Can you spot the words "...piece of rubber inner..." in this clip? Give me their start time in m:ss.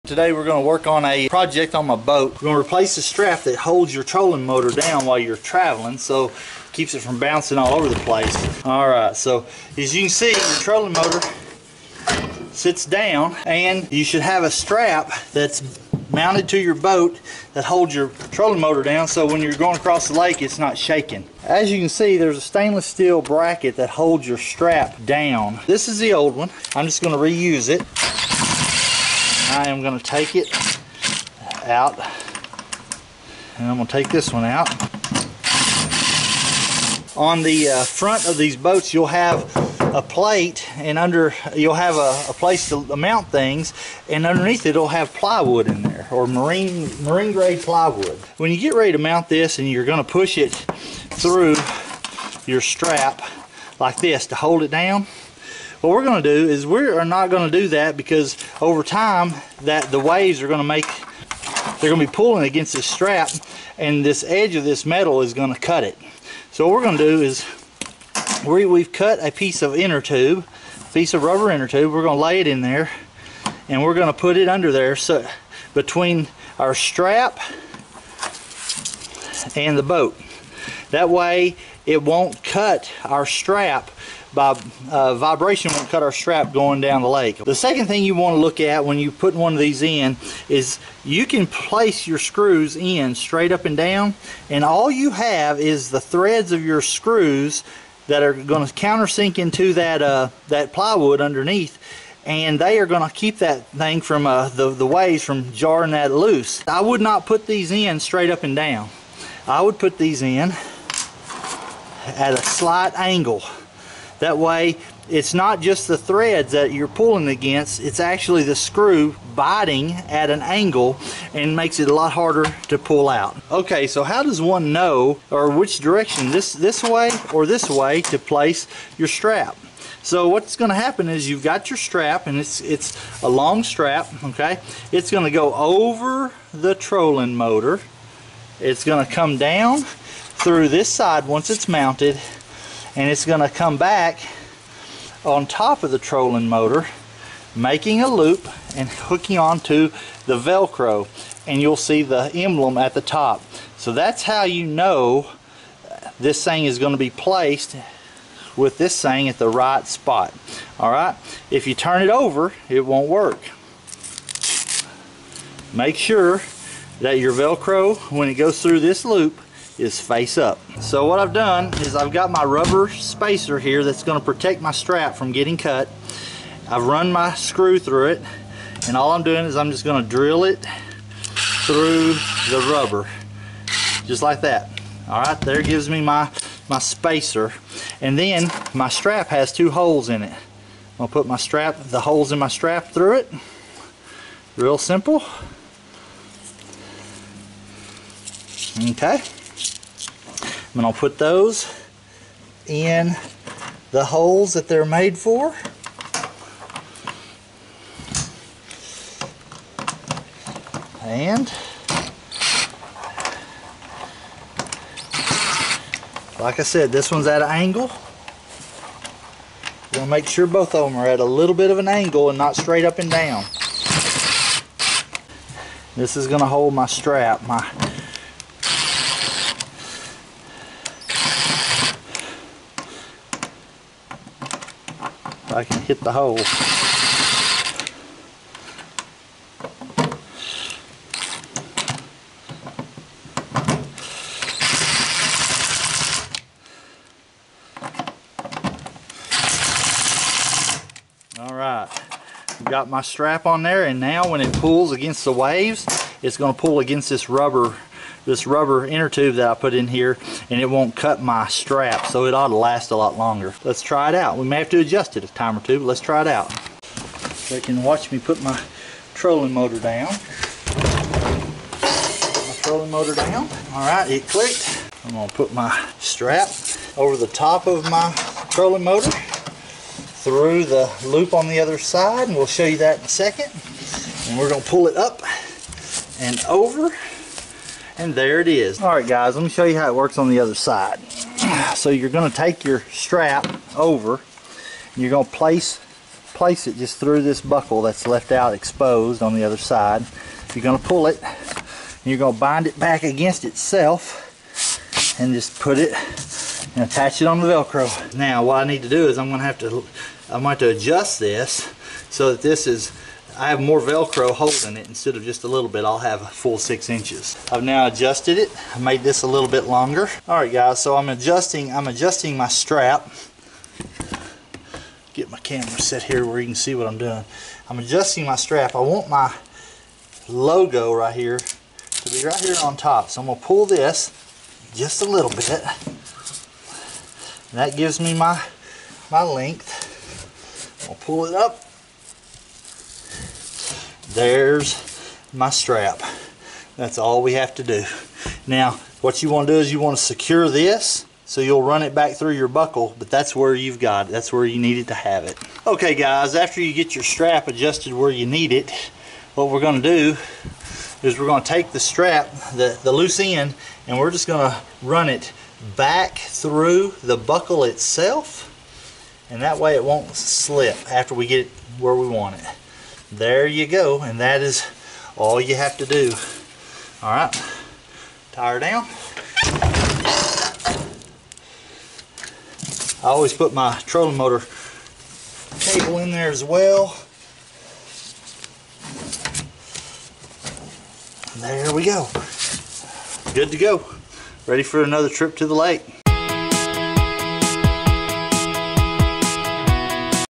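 1:10.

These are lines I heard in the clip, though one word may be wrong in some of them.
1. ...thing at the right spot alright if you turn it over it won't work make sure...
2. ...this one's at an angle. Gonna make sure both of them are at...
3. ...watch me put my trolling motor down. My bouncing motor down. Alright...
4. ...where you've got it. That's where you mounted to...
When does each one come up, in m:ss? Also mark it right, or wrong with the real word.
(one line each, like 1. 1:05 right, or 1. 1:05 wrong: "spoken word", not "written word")
1. 2:39 right
2. 3:36 right
3. 4:27 wrong: "trolling", not "bouncing"
4. 5:53 wrong: "needed", not "mounted".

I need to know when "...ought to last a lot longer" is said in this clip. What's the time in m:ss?
4:22.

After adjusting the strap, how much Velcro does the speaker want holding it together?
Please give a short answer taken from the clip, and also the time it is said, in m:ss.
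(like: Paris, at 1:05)
6 inches, at 5:16.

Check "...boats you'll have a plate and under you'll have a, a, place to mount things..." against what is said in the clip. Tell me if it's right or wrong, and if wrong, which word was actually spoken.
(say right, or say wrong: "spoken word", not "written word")
right.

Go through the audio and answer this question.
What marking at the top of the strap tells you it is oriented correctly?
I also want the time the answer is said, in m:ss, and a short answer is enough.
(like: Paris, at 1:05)
the emblem, at 2:32.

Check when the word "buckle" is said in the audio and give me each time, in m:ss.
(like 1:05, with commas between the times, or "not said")
4:57, 5:52, 6:07.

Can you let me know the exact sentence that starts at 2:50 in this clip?
So what I've done is I've got my rubber spacer here that's going to protect my strap from getting cut.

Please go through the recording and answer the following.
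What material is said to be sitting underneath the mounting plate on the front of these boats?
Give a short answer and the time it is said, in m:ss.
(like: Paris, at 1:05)
marine grade plywood, at 0:47.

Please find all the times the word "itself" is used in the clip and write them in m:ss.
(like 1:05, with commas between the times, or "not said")
5:03, 6:07.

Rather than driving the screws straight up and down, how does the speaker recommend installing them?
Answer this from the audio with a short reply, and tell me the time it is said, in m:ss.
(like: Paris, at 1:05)
at a slight angle, at 1:52.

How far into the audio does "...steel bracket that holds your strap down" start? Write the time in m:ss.
0:22.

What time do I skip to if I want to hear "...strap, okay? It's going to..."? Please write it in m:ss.
2:13.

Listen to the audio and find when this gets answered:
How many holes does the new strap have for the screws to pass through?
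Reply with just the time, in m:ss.
3:09.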